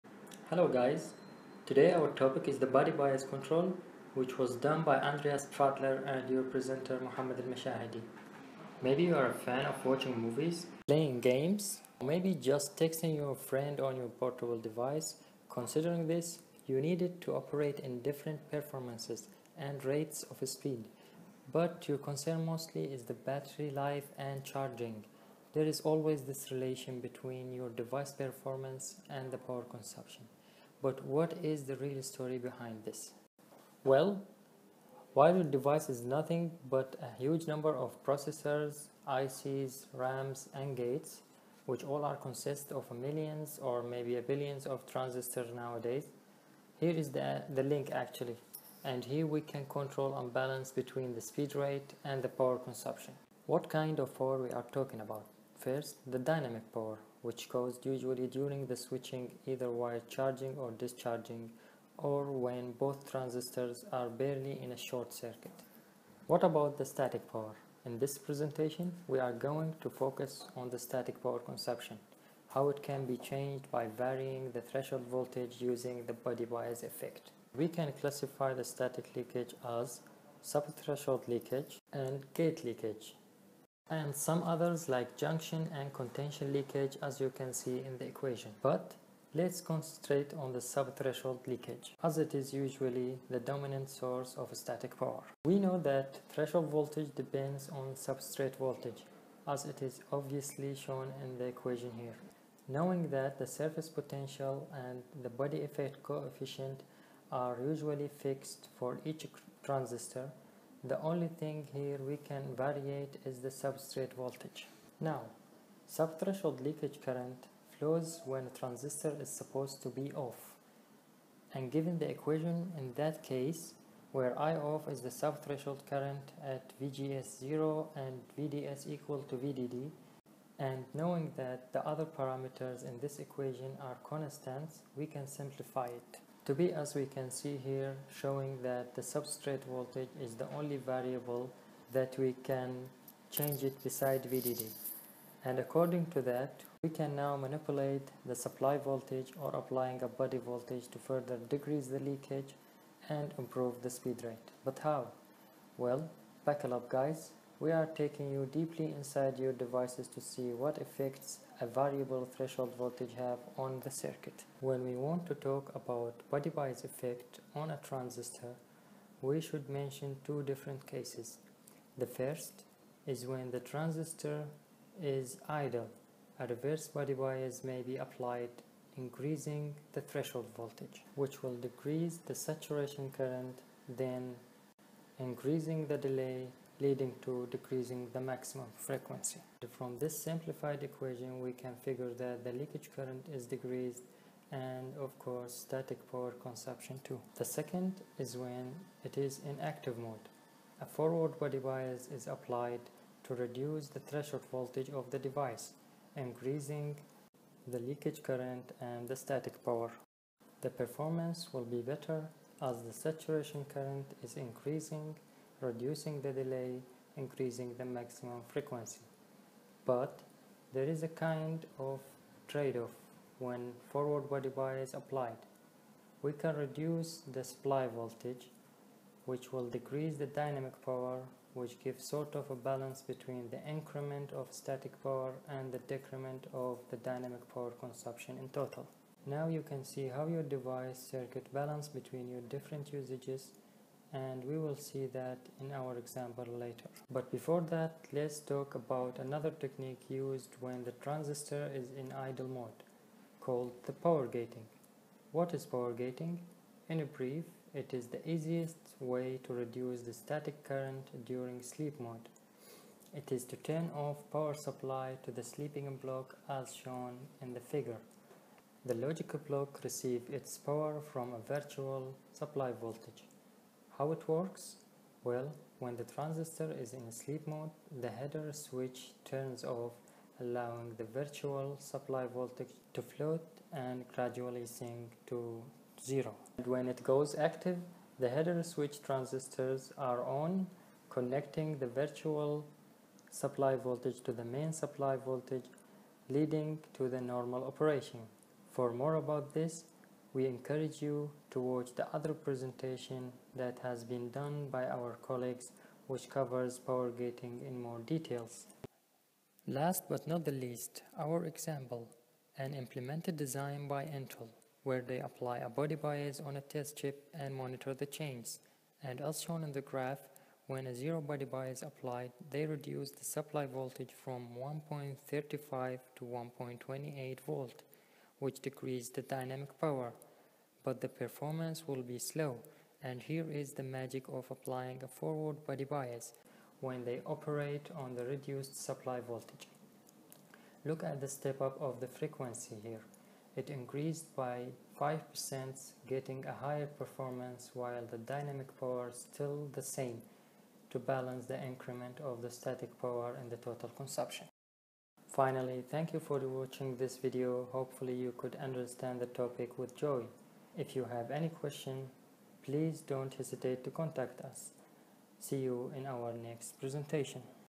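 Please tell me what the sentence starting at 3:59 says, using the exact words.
Now you can see how your device circuit balance between your different usages and we will see that in our example later.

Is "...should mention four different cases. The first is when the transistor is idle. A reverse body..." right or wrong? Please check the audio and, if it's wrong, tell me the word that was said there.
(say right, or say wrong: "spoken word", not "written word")
wrong: "two", not "four".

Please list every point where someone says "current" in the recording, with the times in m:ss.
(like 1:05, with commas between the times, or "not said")
1:57, 2:05, 3:03, 3:12, 3:28, 3:33, 4:20.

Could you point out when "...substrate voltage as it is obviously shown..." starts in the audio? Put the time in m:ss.
1:37.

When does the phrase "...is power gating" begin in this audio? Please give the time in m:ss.
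4:15.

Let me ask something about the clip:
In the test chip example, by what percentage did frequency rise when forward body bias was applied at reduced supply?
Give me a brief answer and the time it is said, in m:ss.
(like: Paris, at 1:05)
5%, at 5:44.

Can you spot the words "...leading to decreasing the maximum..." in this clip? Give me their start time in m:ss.
3:06.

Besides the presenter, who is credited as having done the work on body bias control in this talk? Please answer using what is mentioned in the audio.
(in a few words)
Andreas Pfadler.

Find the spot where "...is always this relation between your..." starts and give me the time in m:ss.
0:25.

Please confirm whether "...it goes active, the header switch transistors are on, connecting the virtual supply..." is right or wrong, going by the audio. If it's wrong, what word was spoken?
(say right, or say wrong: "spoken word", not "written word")
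right.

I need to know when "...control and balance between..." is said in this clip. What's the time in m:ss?
0:49.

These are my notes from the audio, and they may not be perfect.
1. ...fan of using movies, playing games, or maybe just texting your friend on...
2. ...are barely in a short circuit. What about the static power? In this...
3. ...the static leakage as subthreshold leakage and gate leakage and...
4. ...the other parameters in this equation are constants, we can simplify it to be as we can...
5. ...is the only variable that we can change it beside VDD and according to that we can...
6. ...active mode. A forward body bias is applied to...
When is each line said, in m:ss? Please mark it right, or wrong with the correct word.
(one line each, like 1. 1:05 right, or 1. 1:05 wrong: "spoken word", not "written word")
1. 0:09 wrong: "watching", not "using"
2. 1:03 right
3. 1:18 right
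4. 2:11 right
5. 2:20 right
6. 3:19 right.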